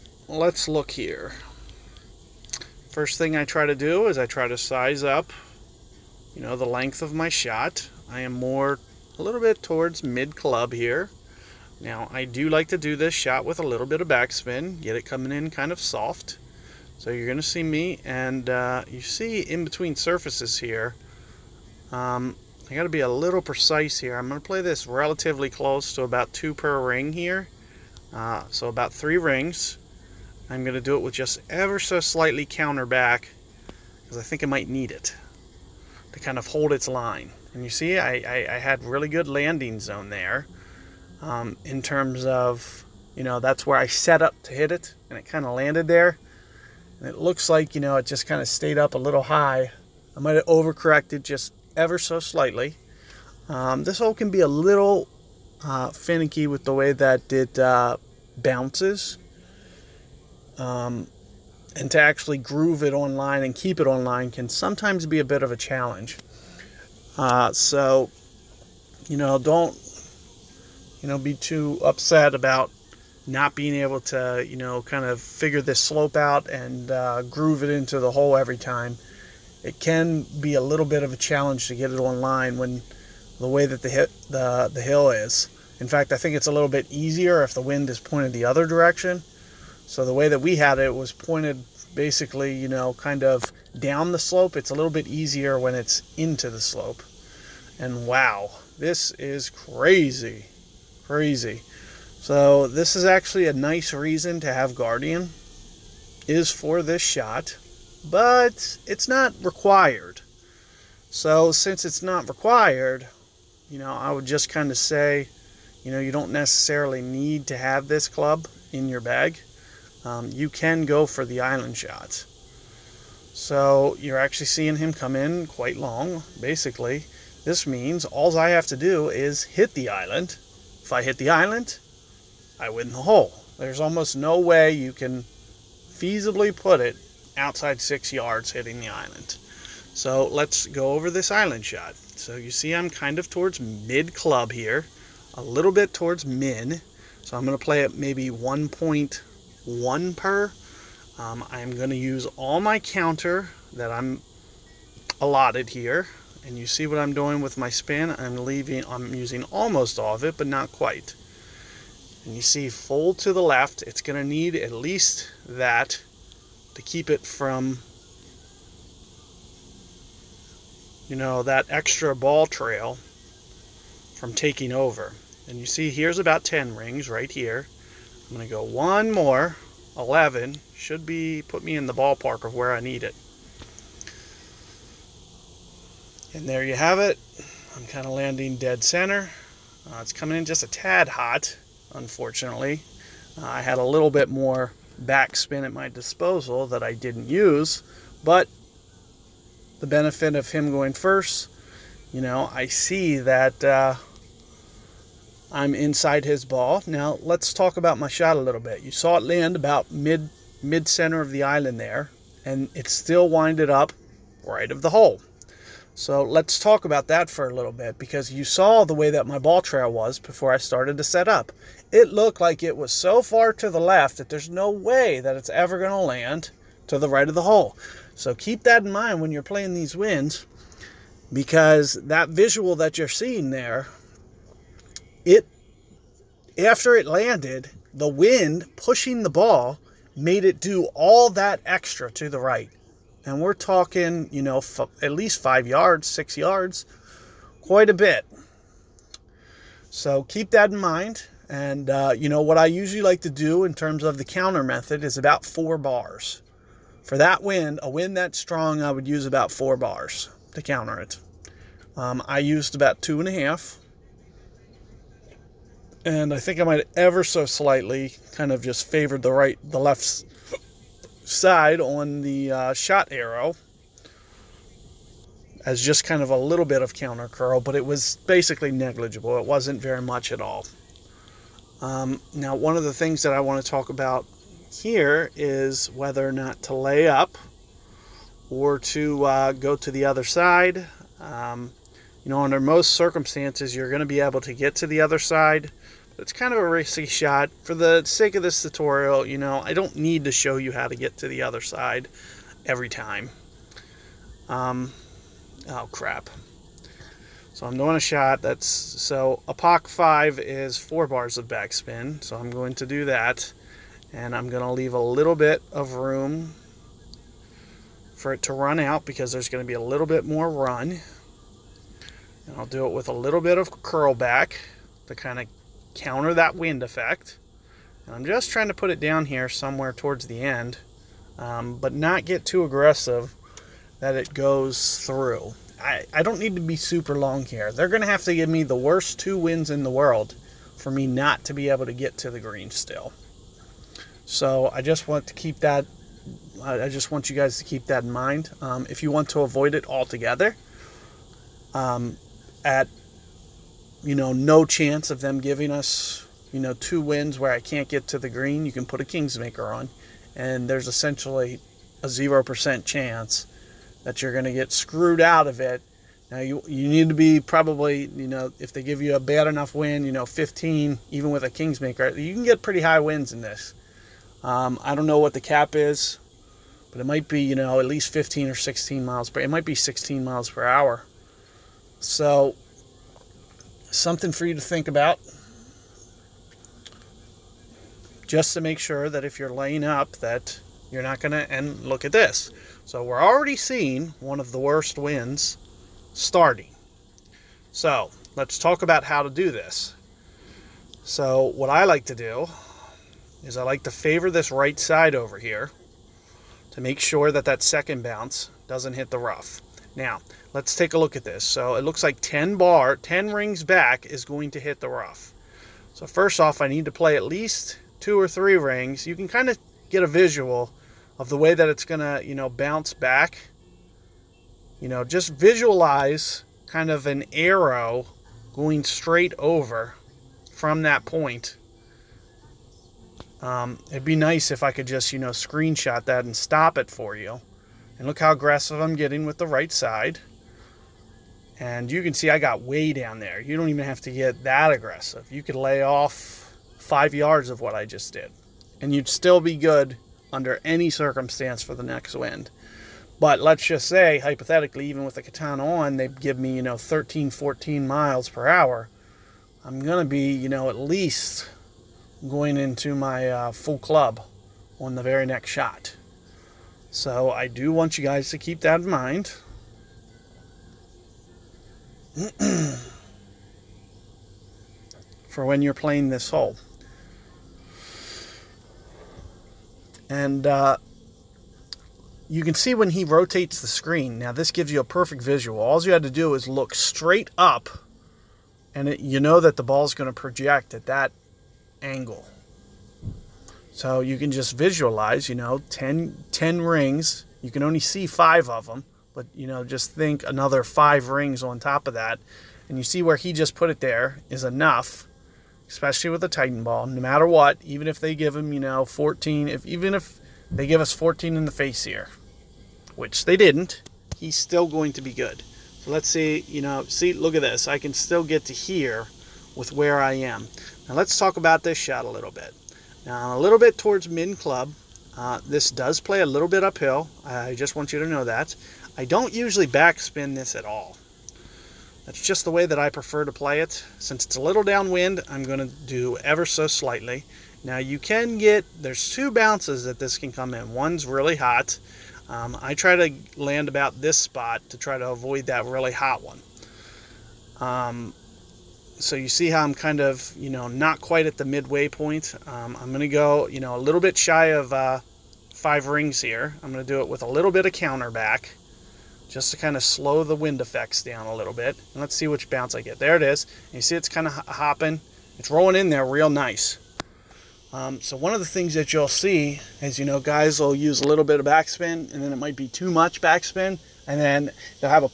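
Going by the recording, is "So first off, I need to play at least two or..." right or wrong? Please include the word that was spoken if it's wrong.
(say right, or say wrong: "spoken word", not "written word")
right.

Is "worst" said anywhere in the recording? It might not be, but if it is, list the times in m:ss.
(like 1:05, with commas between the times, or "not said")
5:38, 6:34.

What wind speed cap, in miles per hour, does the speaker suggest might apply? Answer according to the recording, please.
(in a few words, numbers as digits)
16 mph.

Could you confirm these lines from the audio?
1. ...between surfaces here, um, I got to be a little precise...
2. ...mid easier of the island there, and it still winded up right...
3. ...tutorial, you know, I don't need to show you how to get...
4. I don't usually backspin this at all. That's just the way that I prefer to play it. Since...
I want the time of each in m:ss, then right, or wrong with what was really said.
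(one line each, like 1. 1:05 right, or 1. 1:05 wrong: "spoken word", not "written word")
1. 0:19 right
2. 3:30 wrong: "center", not "easier"
3. 4:58 right
4. 8:48 right.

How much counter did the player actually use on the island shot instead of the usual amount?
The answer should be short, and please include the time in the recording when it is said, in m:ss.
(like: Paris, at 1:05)
2.5 bars, at 4:23.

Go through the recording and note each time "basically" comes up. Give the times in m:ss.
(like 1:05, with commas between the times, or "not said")
1:31, 2:06, 4:38.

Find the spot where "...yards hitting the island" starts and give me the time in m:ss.
2:18.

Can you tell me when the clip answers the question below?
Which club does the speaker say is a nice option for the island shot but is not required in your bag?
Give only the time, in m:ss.
1:44.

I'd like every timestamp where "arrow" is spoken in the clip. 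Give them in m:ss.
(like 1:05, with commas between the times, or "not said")
4:33, 7:07.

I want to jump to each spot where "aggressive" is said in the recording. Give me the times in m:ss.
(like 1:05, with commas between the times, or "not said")
5:32, 7:18, 7:24.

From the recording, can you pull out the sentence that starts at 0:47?
And it looks like, you know, it just kind of stayed up a little high.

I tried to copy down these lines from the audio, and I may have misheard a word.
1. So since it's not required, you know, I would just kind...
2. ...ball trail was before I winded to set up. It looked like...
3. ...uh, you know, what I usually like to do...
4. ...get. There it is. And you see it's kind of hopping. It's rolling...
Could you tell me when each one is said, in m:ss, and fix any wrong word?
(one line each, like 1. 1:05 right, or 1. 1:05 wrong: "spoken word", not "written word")
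1. 1:51 right
2. 3:39 wrong: "started", not "winded"
3. 4:11 right
4. 9:22 right.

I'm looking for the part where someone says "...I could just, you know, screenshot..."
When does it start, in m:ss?
7:14.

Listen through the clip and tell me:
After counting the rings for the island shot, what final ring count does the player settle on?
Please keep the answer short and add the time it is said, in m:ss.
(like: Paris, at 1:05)
11, at 2:59.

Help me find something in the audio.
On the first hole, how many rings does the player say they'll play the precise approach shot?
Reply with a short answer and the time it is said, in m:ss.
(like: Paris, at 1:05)
3 rings, at 0:28.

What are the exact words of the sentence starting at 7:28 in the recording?
And you'd still be good under any circumstance for the next wind.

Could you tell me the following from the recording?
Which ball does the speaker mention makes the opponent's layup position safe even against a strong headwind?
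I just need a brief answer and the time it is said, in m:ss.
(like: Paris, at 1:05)
Titan ball, at 8:26.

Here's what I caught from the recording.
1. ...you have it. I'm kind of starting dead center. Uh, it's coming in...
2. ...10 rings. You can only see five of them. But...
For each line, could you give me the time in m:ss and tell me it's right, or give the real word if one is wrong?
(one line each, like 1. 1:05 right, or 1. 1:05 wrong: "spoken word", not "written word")
1. 3:06 wrong: "landing", not "starting"
2. 8:16 right.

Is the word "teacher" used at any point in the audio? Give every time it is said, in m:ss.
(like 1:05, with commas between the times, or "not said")
not said.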